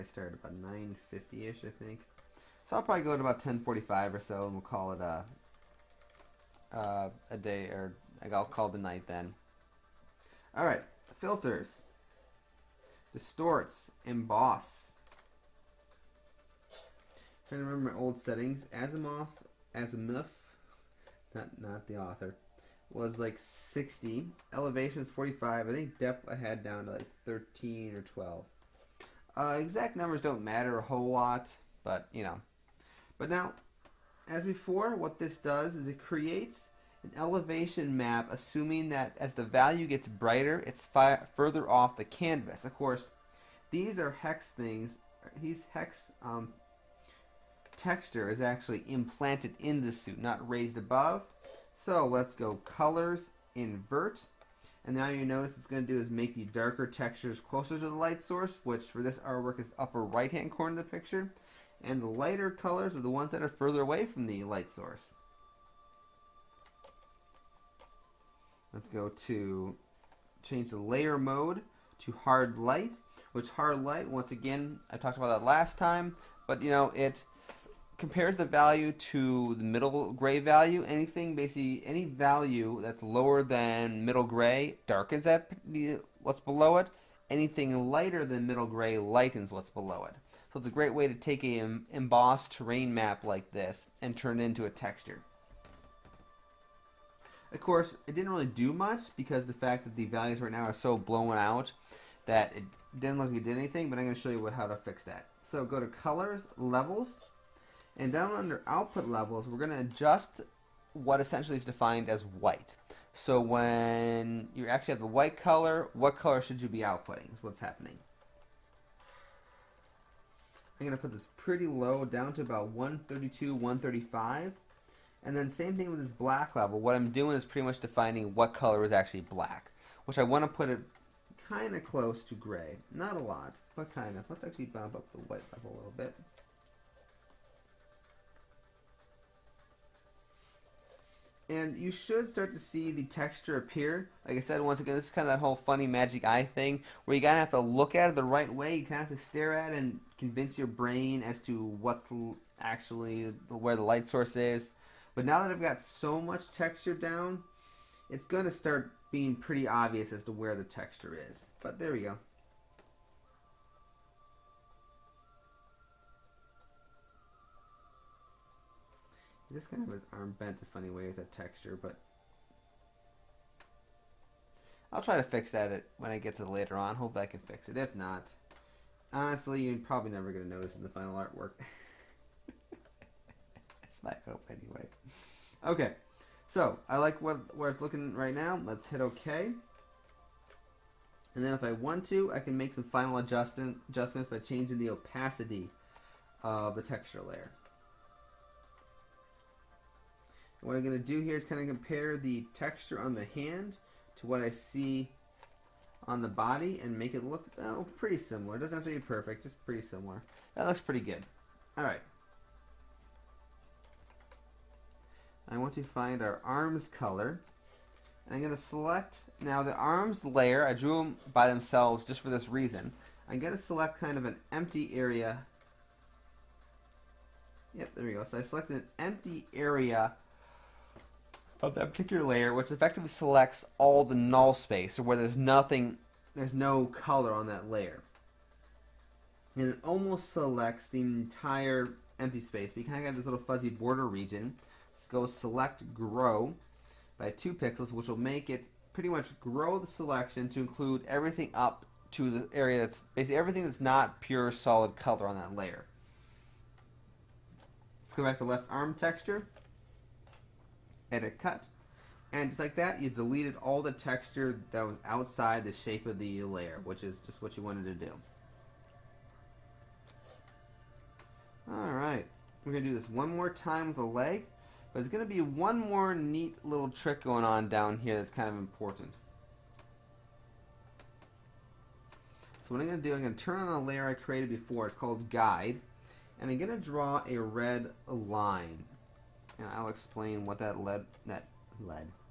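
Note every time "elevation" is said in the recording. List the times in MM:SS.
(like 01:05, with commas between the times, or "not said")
00:24, 00:37.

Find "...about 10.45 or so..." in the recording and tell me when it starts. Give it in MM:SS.
00:03.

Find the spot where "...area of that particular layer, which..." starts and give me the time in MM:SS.
03:49.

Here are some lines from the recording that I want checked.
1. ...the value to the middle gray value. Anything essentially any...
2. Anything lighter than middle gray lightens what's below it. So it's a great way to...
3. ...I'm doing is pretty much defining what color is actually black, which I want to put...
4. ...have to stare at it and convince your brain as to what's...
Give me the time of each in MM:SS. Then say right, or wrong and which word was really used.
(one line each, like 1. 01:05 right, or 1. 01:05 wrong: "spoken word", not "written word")
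1. 01:18 wrong: "basically", not "essentially"
2. 01:27 right
3. 02:06 right
4. 02:29 right.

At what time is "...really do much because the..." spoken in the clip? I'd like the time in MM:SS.
01:38.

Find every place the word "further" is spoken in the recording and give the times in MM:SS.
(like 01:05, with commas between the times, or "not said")
00:41, 01:03.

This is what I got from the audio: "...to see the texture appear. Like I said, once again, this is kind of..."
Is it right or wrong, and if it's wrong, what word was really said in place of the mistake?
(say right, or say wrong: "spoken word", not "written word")
right.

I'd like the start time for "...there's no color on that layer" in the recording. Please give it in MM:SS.
03:56.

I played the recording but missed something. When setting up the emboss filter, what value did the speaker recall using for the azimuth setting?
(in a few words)
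60.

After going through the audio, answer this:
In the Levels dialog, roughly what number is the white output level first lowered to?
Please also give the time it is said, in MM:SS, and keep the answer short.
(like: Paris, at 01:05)
132, at 02:02.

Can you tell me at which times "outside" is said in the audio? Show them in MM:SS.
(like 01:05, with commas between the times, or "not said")
04:25.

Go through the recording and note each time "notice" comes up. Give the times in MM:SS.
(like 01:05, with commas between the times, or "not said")
00:55, 03:00.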